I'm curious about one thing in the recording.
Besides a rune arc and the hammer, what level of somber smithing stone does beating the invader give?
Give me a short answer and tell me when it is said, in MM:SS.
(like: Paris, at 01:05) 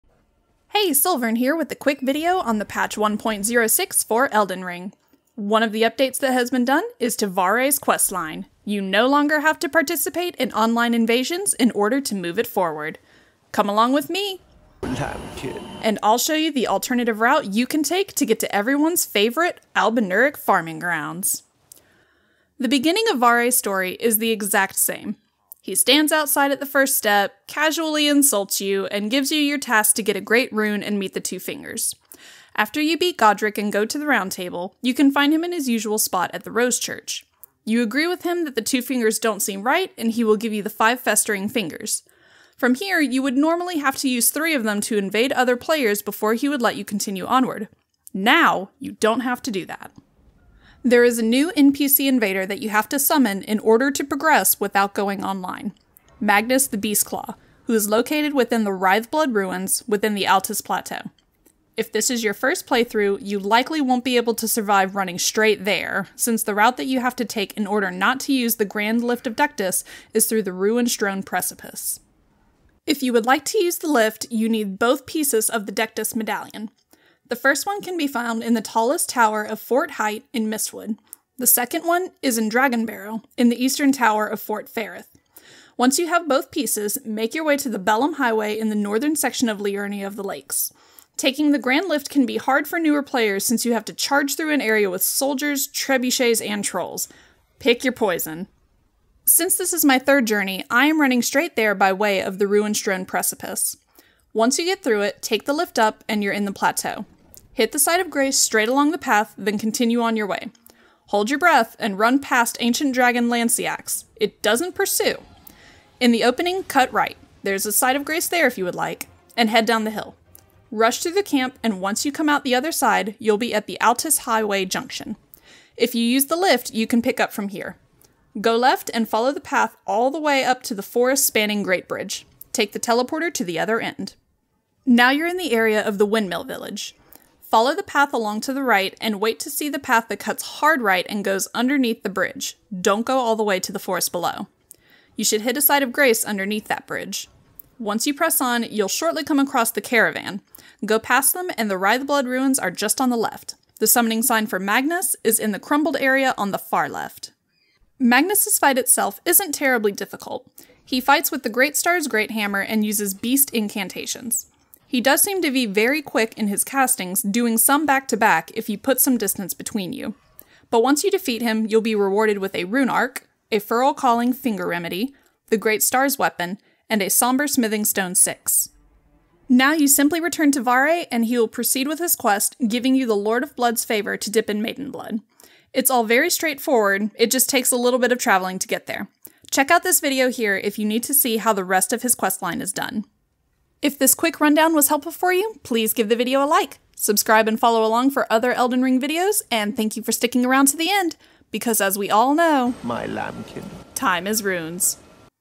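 6, at 02:57.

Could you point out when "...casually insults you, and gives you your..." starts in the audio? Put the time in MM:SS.
00:27.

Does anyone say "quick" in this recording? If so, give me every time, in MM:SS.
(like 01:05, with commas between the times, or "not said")
00:01, 02:46, 03:14.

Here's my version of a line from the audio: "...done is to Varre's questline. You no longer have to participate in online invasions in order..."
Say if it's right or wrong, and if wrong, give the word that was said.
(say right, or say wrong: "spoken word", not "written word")
right.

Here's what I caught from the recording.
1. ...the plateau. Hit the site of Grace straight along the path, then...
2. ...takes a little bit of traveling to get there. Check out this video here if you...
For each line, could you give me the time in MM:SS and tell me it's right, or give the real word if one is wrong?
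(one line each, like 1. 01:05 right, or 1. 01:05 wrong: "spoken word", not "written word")
1. 01:46 right
2. 03:07 right.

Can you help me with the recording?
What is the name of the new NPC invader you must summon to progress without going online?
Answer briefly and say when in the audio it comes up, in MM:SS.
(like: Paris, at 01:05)
Magnus the Beastclaw, at 00:56.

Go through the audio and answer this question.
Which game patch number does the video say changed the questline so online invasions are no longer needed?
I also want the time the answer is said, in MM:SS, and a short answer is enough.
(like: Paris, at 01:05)
1.06, at 00:02.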